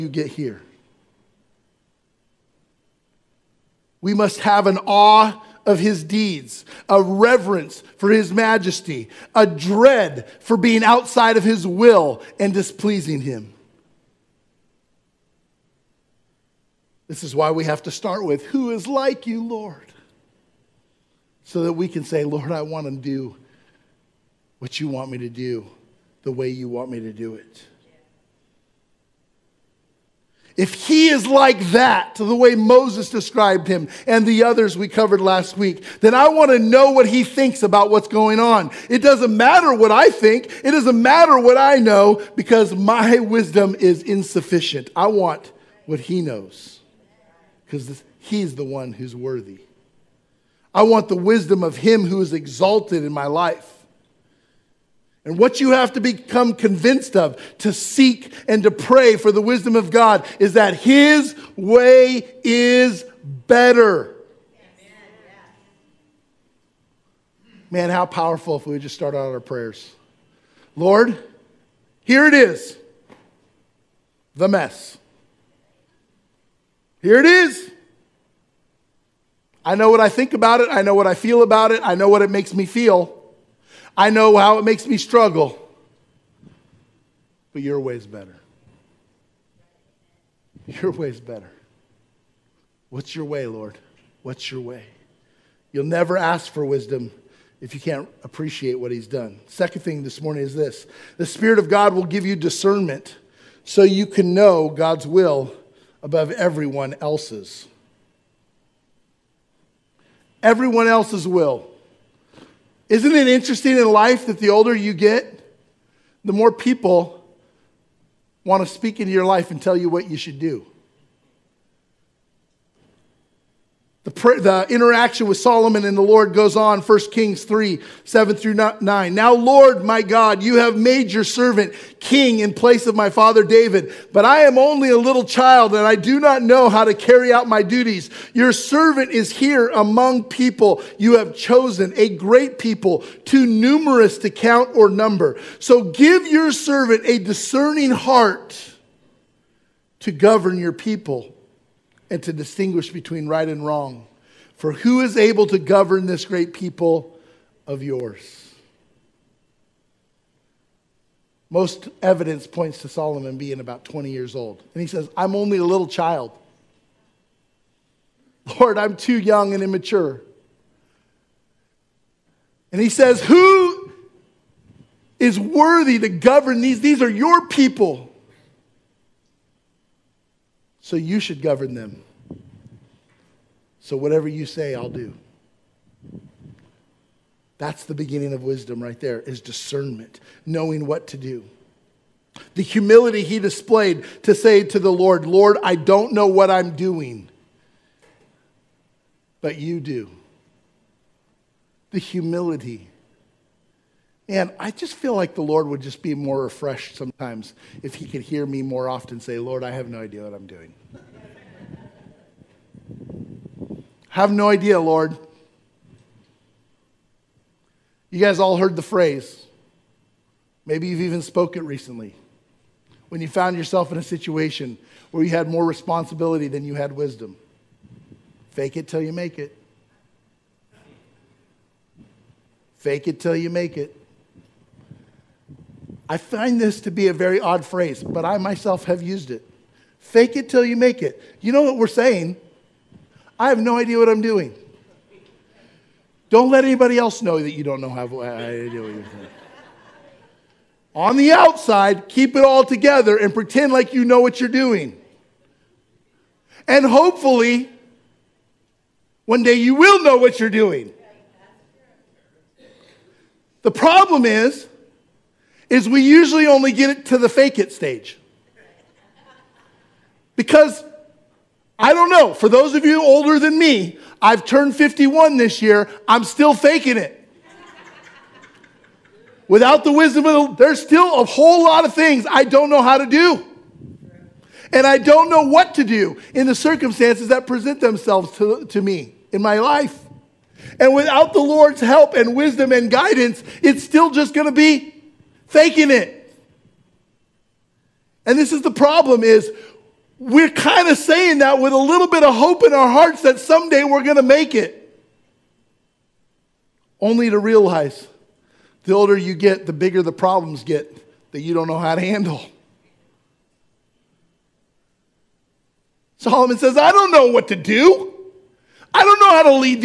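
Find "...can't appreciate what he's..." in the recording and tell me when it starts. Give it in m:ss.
1:37.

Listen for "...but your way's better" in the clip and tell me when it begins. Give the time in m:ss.
1:27.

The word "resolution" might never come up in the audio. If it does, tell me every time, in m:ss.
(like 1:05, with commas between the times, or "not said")
not said.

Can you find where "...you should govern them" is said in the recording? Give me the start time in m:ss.
3:00.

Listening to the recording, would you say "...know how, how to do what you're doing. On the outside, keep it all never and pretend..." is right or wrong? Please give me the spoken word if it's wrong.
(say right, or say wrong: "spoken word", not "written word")
wrong: "together", not "never".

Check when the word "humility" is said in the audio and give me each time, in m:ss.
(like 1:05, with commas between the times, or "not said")
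3:12, 3:21.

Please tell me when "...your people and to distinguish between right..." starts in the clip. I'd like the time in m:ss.
2:30.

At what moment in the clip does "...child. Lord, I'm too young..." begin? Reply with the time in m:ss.
2:45.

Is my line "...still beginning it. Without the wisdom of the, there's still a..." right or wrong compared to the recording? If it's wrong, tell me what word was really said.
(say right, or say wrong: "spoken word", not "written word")
wrong: "faking", not "beginning".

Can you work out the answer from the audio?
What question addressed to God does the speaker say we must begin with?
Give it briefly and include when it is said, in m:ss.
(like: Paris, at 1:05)
Who is like you, Lord?, at 0:18.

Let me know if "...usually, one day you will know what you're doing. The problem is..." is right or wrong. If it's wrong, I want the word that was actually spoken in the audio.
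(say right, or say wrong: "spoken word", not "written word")
wrong: "hopefully", not "usually".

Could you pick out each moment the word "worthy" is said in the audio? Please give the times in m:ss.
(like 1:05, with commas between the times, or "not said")
0:49, 2:55.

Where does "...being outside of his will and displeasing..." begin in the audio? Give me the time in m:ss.
0:10.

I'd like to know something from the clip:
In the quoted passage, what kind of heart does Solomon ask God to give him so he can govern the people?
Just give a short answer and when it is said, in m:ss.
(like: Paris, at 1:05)
a discerning heart, at 2:27.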